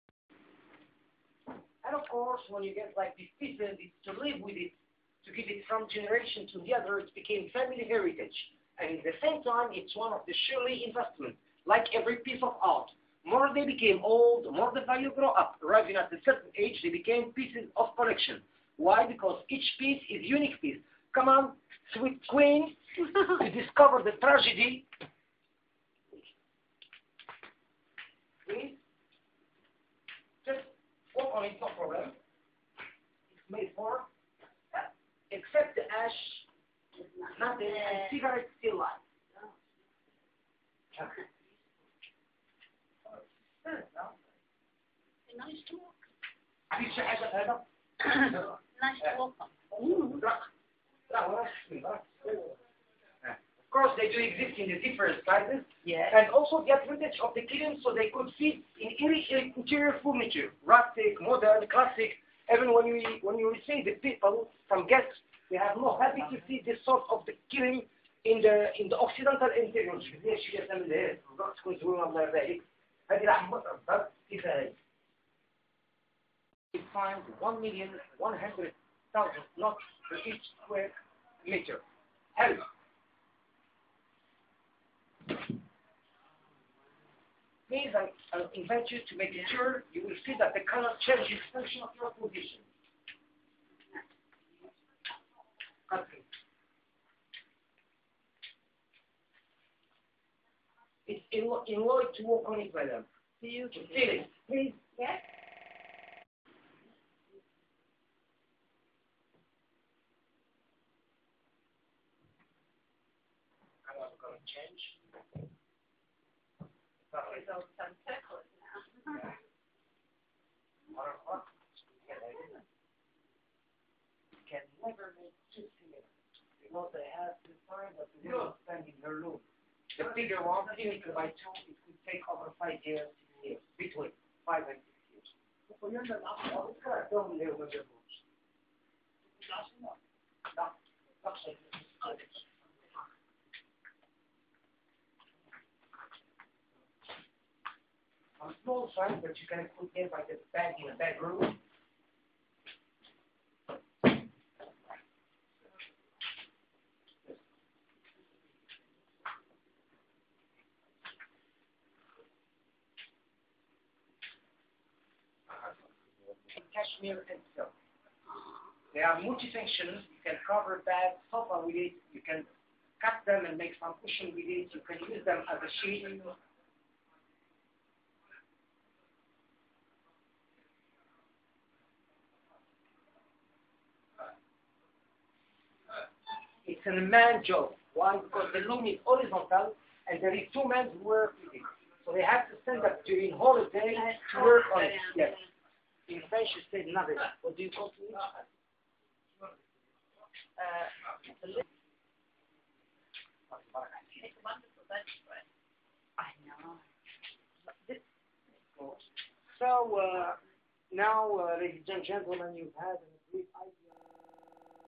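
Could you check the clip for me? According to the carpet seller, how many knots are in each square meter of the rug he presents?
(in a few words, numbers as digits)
1,100,000.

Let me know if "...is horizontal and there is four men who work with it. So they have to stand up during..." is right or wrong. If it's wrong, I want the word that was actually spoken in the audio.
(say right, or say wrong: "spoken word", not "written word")
wrong: "two", not "four".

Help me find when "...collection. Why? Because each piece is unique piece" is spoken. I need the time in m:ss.
0:17.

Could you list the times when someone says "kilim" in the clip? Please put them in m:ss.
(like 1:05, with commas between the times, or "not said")
0:57, 1:07.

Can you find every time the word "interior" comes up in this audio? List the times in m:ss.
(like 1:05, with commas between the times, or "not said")
0:59, 1:09.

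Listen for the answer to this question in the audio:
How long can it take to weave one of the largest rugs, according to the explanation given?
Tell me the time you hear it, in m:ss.
2:13.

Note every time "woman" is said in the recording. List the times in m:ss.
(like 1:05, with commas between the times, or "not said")
2:08.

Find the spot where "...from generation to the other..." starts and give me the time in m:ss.
0:05.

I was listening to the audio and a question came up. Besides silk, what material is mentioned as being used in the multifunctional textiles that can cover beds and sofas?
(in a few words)
cashmere.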